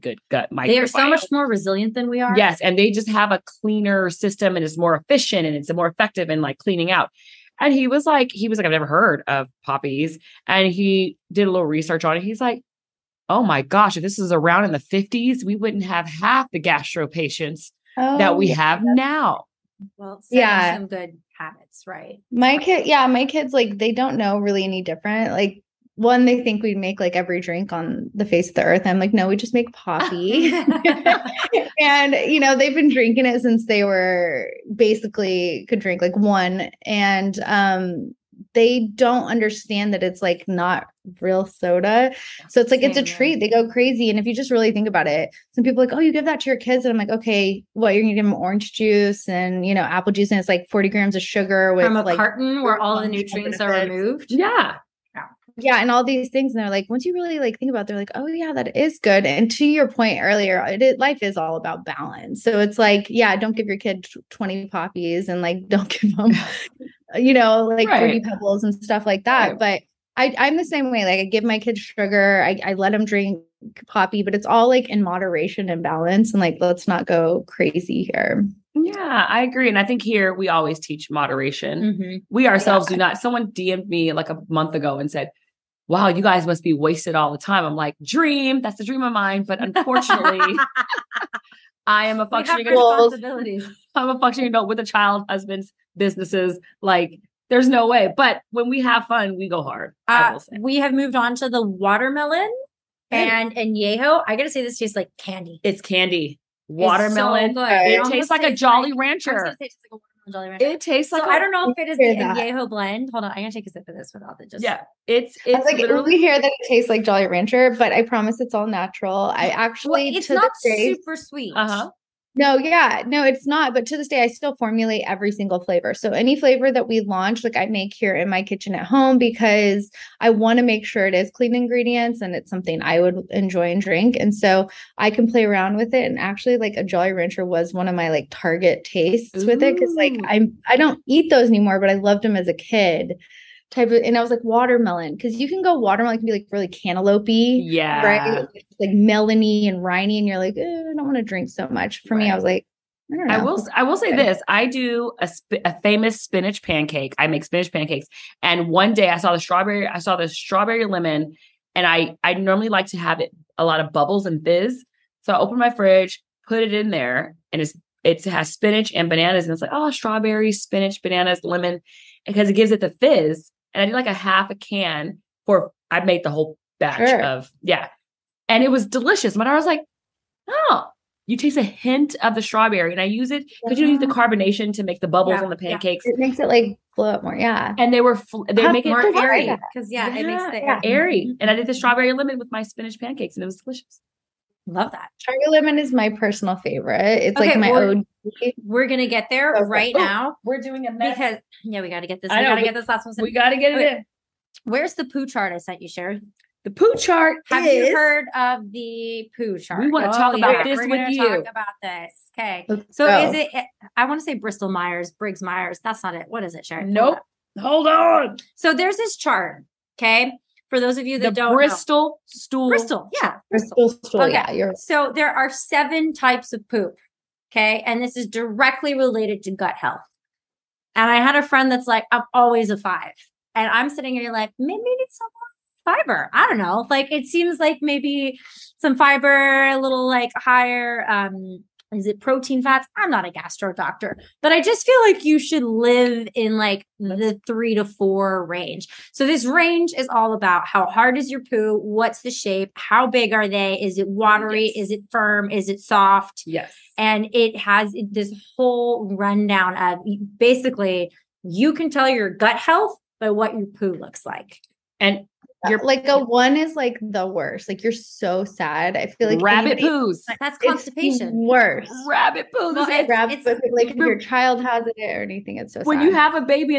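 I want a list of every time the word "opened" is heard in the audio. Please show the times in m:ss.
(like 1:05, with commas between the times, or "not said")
2:45.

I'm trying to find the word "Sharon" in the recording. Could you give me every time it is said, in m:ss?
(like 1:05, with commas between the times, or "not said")
3:36.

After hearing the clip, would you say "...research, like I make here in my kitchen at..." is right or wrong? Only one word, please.
wrong.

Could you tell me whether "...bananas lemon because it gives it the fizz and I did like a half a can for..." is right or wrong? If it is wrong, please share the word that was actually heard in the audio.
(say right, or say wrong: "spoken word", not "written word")
right.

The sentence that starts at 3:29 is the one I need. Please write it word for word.
We want to oh, talk about yeah.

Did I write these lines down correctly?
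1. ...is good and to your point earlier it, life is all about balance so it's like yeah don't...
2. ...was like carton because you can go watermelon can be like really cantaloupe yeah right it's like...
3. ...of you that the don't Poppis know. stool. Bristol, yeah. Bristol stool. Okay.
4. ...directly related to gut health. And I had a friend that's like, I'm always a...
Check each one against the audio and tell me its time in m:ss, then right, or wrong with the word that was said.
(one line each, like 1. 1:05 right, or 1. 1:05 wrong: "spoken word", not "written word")
1. 0:58 right
2. 2:24 wrong: "watermelon", not "carton"
3. 3:40 wrong: "Bristol", not "Poppis"
4. 3:48 right.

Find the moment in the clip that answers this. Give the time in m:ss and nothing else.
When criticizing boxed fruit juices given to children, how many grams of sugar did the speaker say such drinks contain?
0:50.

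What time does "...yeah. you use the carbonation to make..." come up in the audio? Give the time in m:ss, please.
3:03.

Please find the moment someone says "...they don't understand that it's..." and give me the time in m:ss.
0:38.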